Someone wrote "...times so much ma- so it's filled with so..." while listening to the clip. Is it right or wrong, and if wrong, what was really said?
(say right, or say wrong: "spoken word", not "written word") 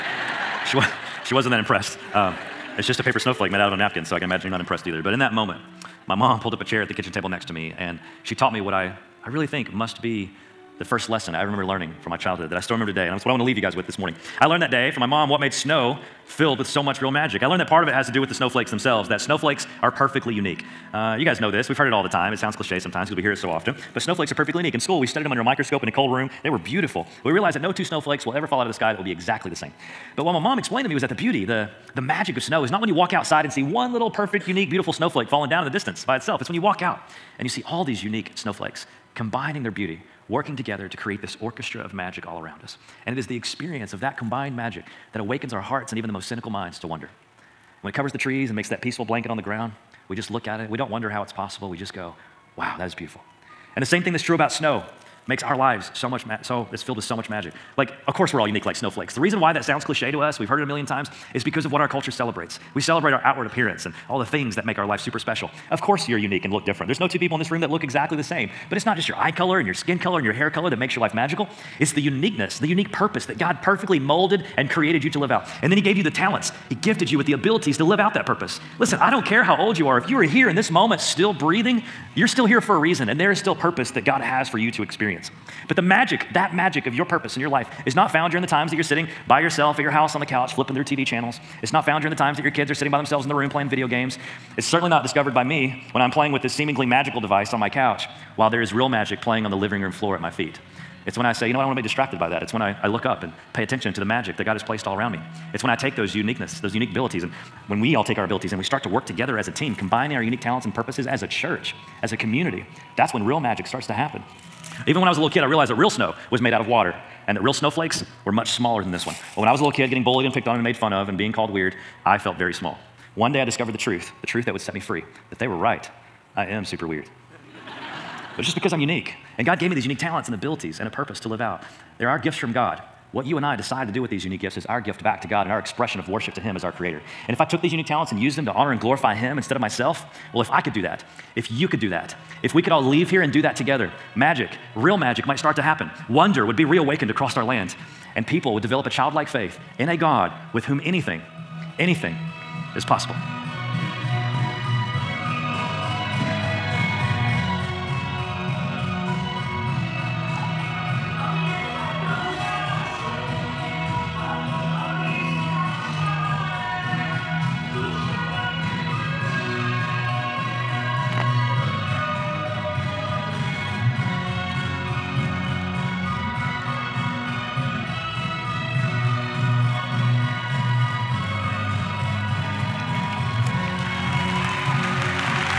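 wrong: "lives", not "times".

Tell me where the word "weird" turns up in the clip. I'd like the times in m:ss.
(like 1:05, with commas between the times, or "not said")
2:01, 2:06.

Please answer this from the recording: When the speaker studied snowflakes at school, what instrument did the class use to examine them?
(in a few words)
Microscope.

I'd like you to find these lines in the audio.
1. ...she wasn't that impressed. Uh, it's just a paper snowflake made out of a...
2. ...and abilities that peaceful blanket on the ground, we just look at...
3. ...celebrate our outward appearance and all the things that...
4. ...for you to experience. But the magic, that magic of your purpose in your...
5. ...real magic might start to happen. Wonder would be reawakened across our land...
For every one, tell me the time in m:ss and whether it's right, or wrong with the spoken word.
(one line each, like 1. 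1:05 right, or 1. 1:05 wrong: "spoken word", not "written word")
1. 0:01 right
2. 0:48 wrong: "makes", not "abilities"
3. 1:02 right
4. 1:24 right
5. 2:24 right.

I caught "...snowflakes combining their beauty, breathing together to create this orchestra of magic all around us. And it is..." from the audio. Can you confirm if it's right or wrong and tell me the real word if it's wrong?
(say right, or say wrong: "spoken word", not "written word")
wrong: "working", not "breathing".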